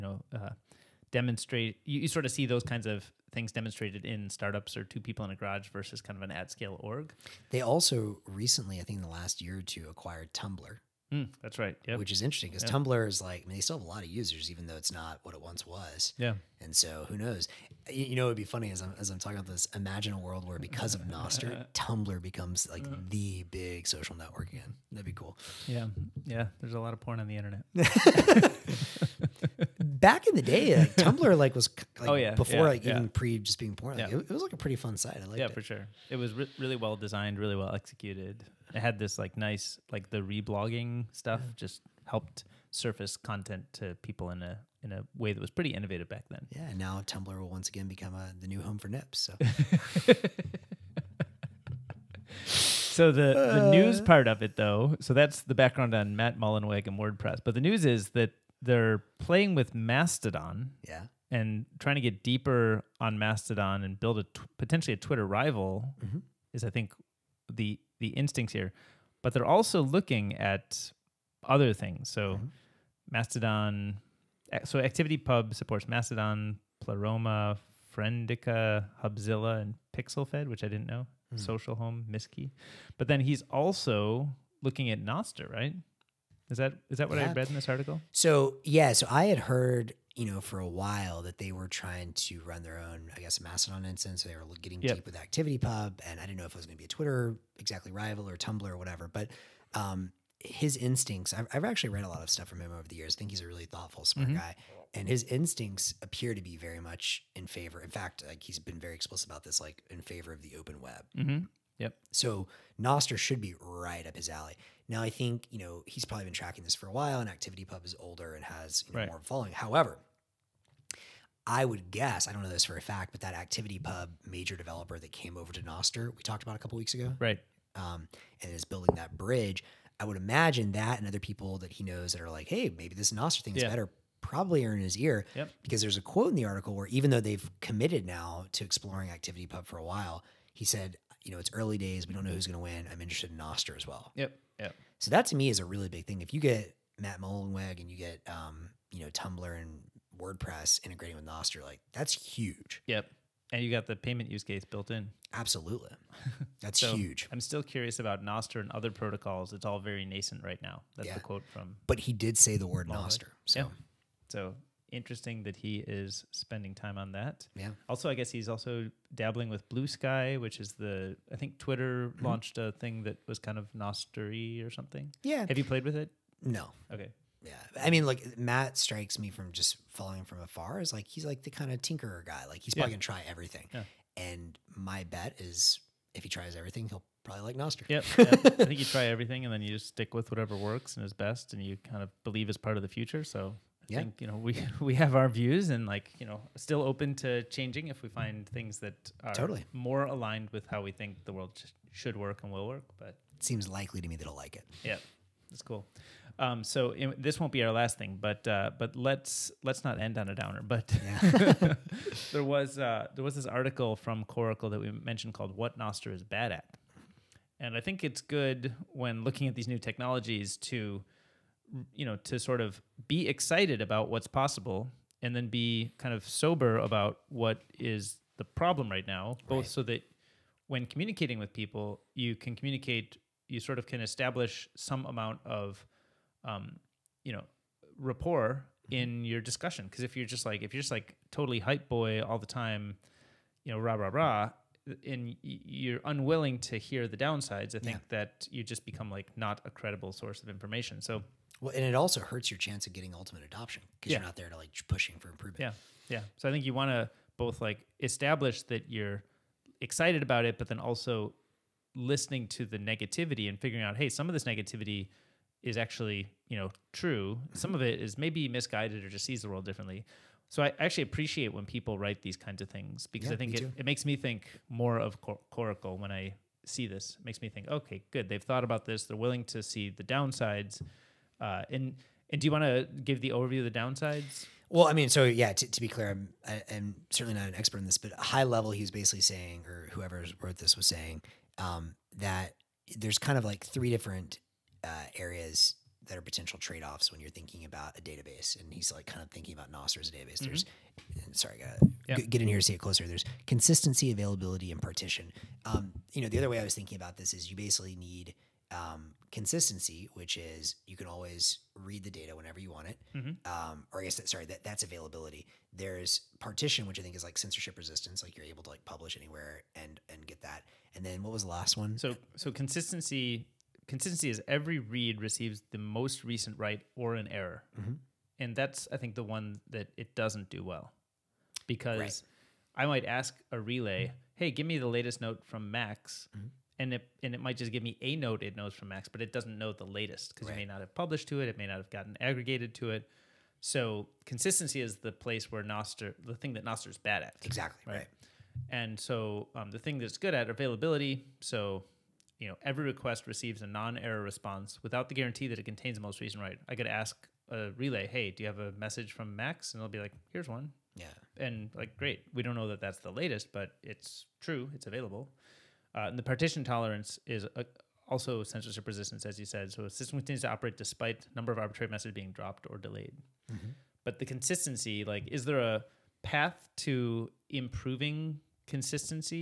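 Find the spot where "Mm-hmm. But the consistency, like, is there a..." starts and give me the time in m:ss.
6:13.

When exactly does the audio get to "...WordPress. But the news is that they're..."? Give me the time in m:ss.
0:56.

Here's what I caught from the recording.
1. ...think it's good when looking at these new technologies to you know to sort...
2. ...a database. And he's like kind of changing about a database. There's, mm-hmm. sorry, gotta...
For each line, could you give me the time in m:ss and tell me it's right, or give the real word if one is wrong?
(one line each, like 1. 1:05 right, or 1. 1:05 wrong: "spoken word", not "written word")
1. 3:37 right
2. 4:57 wrong: "thinking", not "changing".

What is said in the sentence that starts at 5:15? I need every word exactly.
There's partition, which I think is like censorship resistance, like you're able to like publish anywhere and and get that.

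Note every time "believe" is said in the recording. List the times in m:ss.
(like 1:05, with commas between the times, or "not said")
3:12.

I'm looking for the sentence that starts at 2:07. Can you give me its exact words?
Um, and is building that bridge.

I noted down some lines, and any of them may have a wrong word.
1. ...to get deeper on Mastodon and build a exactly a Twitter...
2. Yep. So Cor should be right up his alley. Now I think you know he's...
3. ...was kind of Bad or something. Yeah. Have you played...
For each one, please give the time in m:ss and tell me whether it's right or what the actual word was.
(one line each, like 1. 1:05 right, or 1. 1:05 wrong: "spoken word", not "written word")
1. 1:01 wrong: "potentially", not "exactly"
2. 1:51 wrong: "Nostr", not "Cor"
3. 2:53 wrong: "Nostery", not "Bad".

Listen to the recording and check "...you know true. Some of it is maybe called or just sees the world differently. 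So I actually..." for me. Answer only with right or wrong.
wrong.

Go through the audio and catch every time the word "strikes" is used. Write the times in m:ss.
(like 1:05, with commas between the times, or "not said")
2:58.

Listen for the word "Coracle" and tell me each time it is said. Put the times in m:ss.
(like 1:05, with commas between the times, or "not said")
3:34, 4:35.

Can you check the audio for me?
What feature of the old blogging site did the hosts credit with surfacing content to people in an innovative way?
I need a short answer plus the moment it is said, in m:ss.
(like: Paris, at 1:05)
Reblogging, at 0:40.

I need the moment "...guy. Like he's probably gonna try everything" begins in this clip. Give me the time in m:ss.
3:02.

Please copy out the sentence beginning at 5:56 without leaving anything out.
I could ask a relay, "Hey, do you have a message from Max?" and it'll be like, "Here's one." Yeah.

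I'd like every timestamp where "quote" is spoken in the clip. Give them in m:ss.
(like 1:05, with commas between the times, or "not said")
2:16, 2:41.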